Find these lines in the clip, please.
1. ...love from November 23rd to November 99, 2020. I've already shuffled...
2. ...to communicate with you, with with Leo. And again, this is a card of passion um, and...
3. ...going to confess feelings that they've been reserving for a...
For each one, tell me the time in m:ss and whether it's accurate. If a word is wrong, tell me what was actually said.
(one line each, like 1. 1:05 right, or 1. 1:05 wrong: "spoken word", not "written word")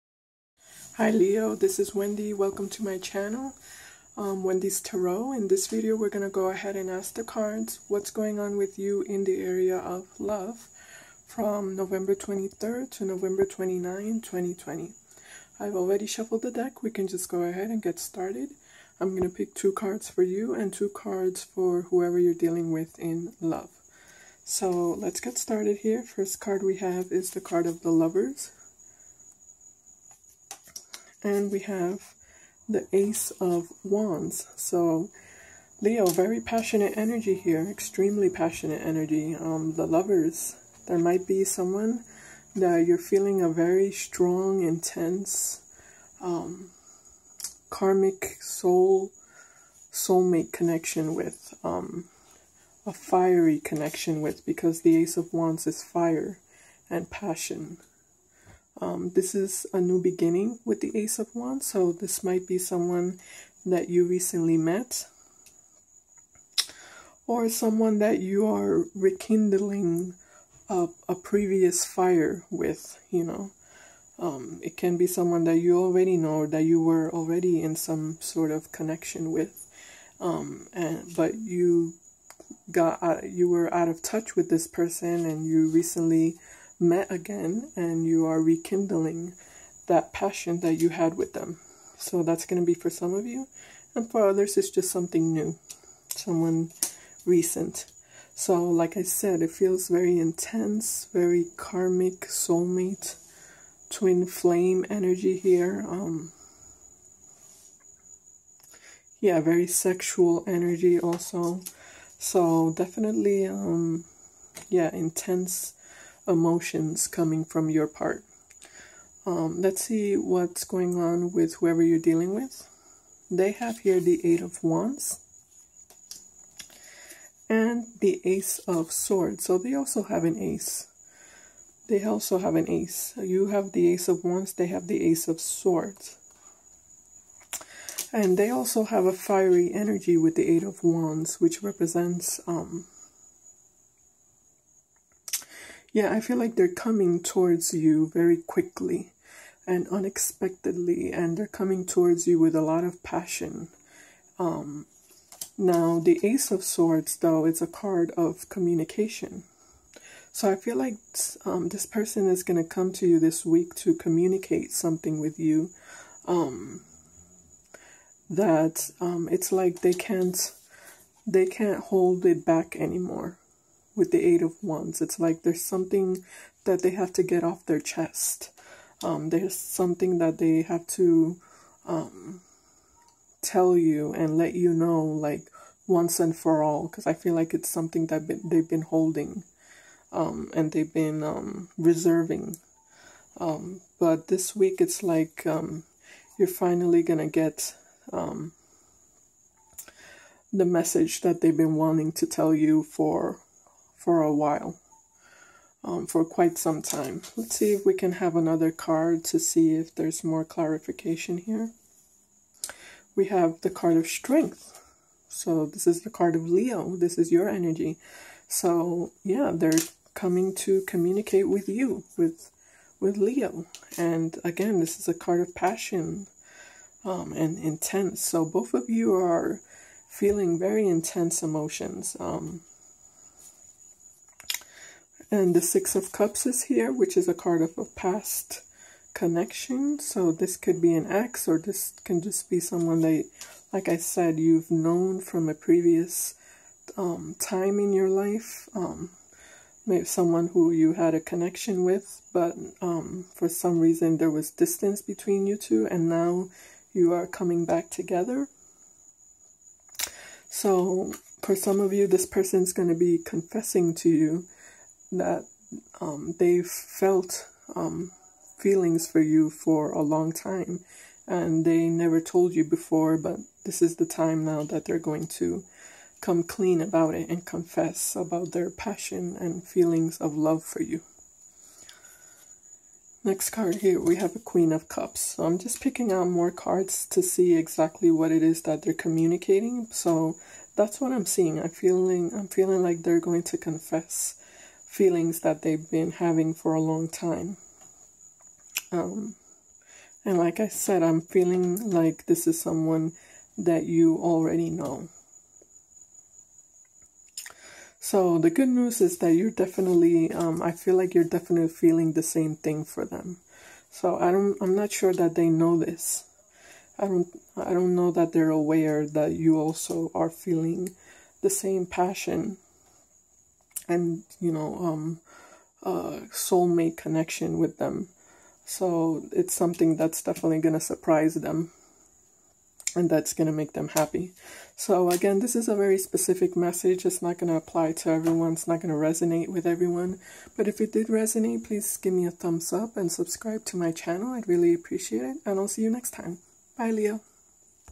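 1. 0:10 wrong: "29", not "99"
2. 3:40 right
3. 4:53 wrong: "having", not "reserving".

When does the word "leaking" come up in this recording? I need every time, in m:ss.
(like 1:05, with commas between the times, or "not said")
not said.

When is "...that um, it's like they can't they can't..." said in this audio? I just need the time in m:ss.
2:48.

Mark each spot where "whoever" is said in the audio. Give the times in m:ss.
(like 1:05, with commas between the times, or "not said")
0:21, 2:01.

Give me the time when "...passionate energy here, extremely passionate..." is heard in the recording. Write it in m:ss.
0:36.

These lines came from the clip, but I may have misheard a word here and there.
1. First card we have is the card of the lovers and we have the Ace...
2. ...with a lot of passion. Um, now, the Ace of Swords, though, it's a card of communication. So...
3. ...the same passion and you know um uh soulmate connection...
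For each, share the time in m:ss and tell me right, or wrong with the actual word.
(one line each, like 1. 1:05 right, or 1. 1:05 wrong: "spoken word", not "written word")
1. 0:26 right
2. 2:32 right
3. 5:21 right.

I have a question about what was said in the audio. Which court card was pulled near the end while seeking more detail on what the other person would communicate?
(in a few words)
Queen of Cups.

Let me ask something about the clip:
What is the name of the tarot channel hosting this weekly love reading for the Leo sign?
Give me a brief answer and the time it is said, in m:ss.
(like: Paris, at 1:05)
Wendy's Tarot, at 0:04.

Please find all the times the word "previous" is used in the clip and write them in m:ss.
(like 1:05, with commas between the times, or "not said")
1:11, 4:05.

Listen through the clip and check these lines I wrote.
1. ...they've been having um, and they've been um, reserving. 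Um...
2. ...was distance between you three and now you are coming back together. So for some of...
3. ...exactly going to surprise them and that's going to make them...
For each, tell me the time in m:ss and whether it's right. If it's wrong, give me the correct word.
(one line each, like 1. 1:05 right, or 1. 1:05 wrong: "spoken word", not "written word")
1. 3:08 wrong: "holding", not "having"
2. 4:14 wrong: "two", not "three"
3. 5:30 wrong: "definitely", not "exactly".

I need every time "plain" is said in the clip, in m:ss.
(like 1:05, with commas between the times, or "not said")
not said.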